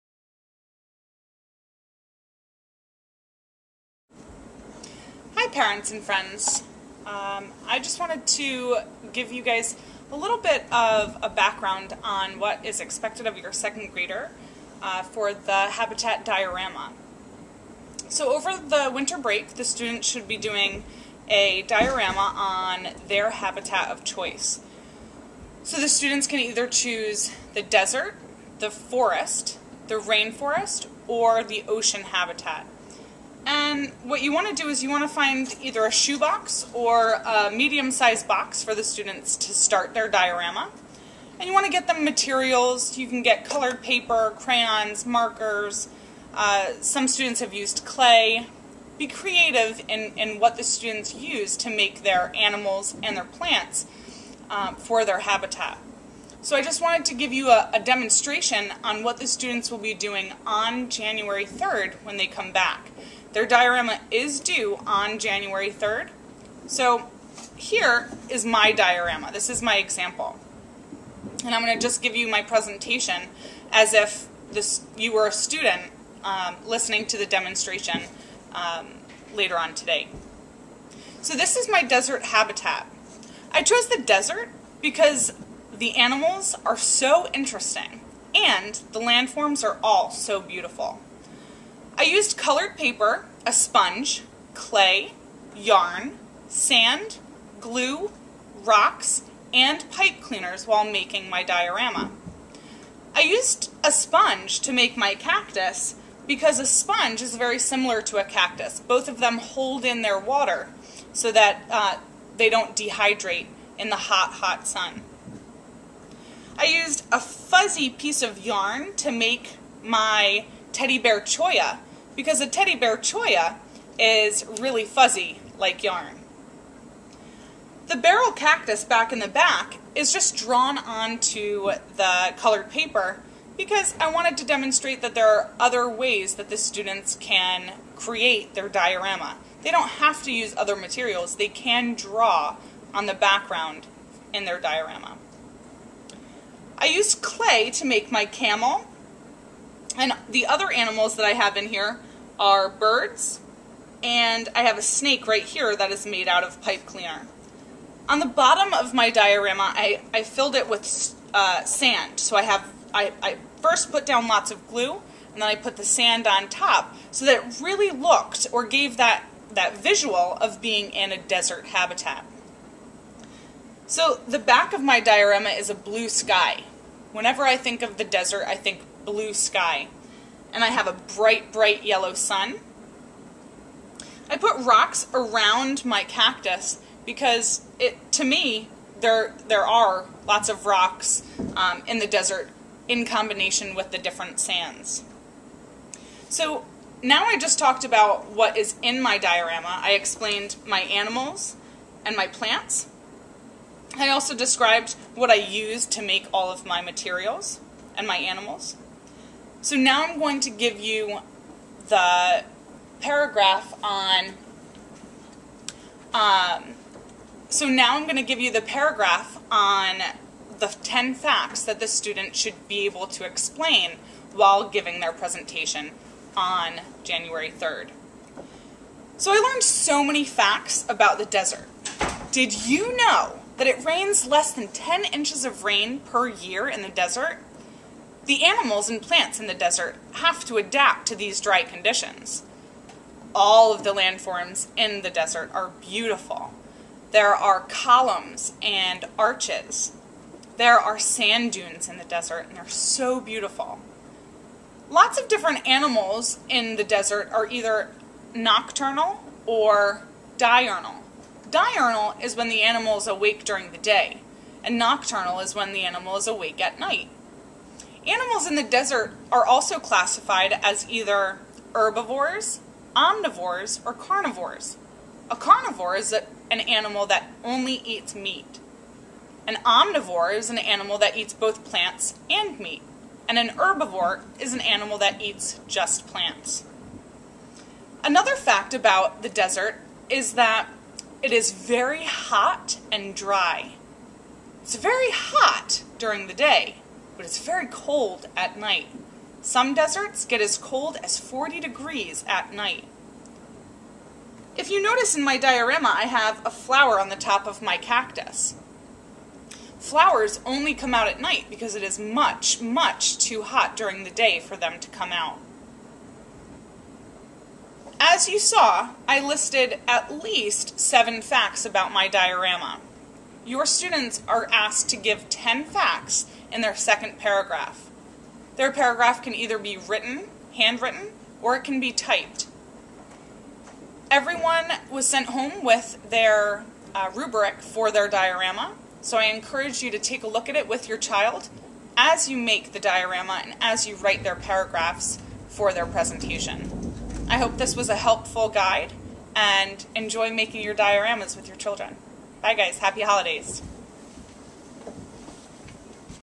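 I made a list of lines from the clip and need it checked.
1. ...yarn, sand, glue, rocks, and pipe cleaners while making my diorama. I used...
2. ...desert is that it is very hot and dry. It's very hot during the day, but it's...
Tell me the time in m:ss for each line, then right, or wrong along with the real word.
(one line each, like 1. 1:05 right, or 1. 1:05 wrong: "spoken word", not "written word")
1. 1:35 right
2. 4:49 right.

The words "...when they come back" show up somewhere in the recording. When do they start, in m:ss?
1:02.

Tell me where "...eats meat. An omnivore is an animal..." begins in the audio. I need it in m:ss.
4:37.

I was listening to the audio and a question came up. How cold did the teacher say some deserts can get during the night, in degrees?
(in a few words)
40 degrees.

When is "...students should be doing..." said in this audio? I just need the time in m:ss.
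0:19.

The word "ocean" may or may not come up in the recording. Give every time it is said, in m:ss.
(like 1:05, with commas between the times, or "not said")
0:31.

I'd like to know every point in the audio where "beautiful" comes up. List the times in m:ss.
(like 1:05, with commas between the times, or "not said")
1:30, 4:05, 4:13.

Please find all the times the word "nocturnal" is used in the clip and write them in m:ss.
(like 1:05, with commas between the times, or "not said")
4:18, 4:24.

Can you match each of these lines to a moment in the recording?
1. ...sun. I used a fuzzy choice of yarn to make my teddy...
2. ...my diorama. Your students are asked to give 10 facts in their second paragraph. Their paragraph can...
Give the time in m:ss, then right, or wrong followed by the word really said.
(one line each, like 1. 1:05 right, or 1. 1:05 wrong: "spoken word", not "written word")
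1. 1:54 wrong: "piece", not "choice"
2. 5:21 right.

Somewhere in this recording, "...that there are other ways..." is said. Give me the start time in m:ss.
2:15.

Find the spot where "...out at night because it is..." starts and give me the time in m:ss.
5:10.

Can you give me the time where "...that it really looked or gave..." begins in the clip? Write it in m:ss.
2:47.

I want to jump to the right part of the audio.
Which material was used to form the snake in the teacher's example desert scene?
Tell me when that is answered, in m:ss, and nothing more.
2:36.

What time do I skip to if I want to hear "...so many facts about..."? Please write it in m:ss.
3:49.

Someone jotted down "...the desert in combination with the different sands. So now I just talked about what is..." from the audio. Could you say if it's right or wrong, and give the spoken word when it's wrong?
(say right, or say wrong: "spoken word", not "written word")
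right.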